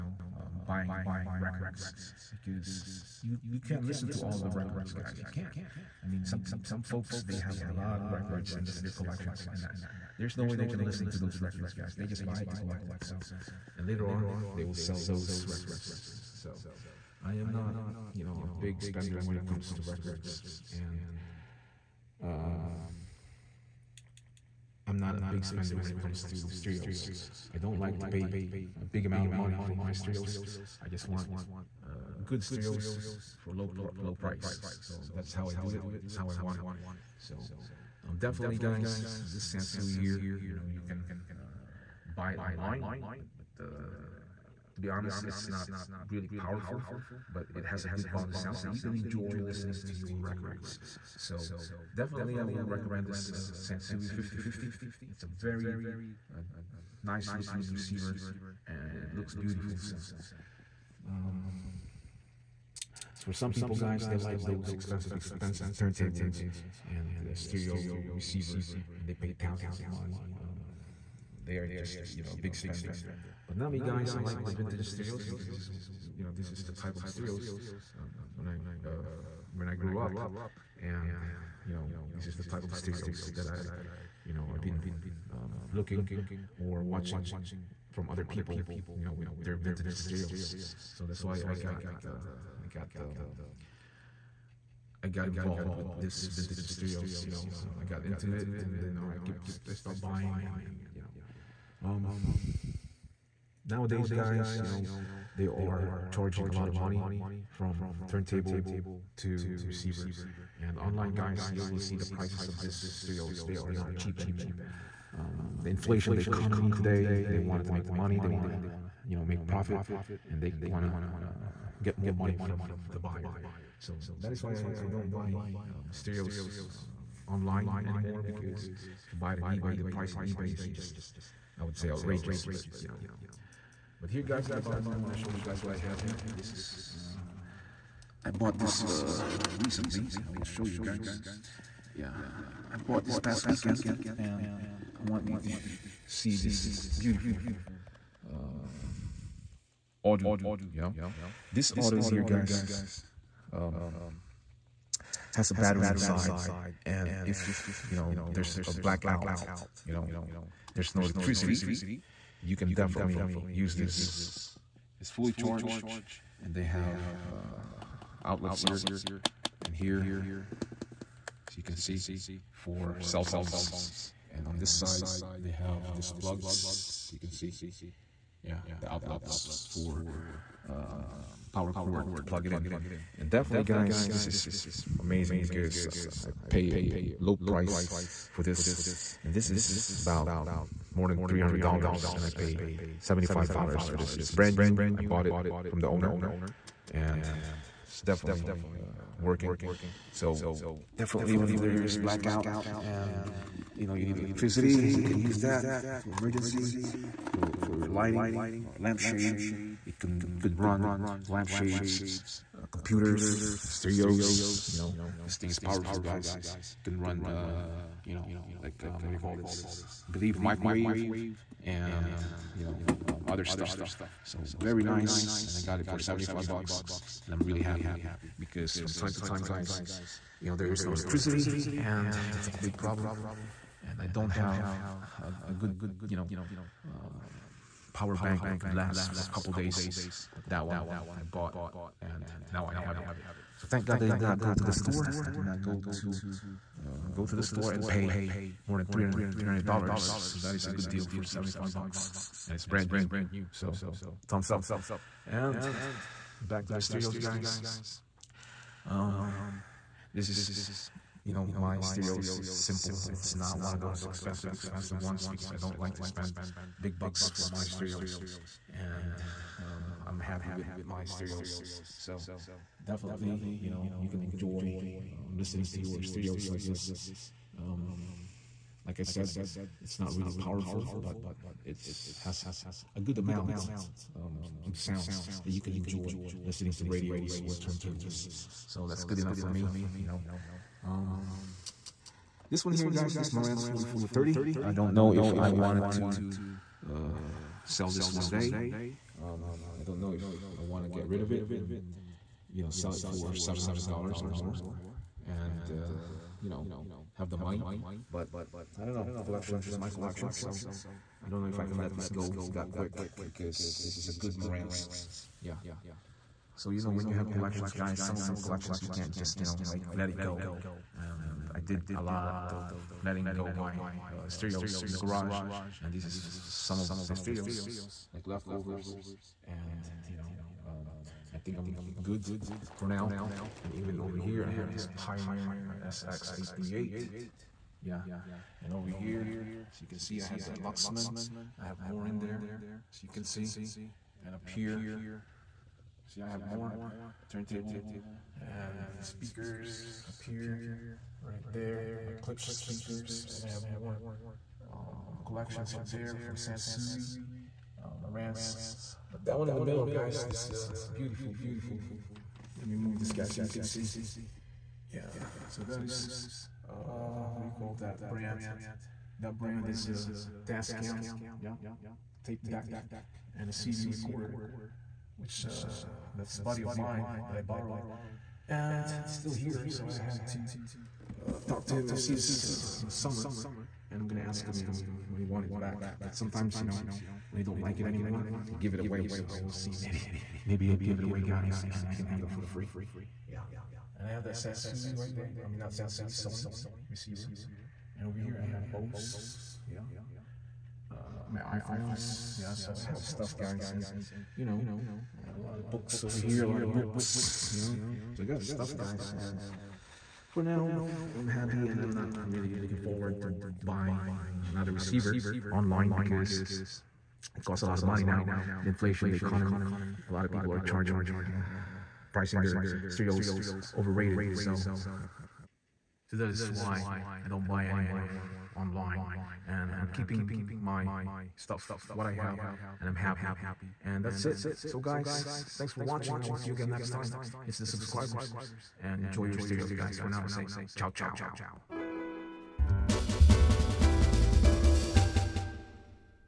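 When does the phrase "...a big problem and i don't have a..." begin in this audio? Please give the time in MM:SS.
03:52.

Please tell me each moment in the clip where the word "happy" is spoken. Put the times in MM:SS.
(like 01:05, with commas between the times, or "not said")
03:47, 04:30, 06:51, 07:12.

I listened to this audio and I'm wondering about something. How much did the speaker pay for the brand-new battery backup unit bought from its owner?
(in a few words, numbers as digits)
$75.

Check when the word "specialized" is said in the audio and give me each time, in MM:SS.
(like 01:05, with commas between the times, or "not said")
not said.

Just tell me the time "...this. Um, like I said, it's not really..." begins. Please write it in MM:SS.
04:36.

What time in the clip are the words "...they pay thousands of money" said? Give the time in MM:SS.
01:09.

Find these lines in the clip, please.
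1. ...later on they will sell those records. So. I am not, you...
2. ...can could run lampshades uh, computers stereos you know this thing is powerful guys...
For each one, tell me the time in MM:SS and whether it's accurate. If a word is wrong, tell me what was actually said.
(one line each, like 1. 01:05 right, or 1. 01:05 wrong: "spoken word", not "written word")
1. 00:13 right
2. 03:29 right.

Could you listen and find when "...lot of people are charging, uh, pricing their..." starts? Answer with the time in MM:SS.
07:00.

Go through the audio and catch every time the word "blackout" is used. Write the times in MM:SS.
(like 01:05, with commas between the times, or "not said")
02:38, 03:21.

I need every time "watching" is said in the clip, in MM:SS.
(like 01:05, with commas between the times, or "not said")
01:26, 07:15.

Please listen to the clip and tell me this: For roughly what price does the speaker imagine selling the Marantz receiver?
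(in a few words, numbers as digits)
$700.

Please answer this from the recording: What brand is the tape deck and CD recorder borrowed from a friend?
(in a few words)
Tascam.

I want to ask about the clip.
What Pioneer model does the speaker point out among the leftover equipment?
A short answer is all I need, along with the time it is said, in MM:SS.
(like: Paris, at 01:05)
SX838, at 05:35.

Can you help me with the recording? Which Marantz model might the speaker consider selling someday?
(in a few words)
Marantz 4430.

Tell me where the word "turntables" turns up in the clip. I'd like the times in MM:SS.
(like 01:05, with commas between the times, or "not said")
01:05, 01:48, 04:47, 05:47.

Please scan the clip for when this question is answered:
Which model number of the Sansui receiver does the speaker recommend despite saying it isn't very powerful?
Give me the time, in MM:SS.
00:53.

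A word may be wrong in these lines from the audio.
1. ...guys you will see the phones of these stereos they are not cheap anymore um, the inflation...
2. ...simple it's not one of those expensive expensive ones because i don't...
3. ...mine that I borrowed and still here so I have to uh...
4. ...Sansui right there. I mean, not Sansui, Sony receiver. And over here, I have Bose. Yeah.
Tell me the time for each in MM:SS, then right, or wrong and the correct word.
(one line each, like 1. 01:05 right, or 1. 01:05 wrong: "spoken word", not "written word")
1. 01:51 wrong: "prices", not "phones"
2. 04:22 right
3. 06:16 right
4. 06:34 right.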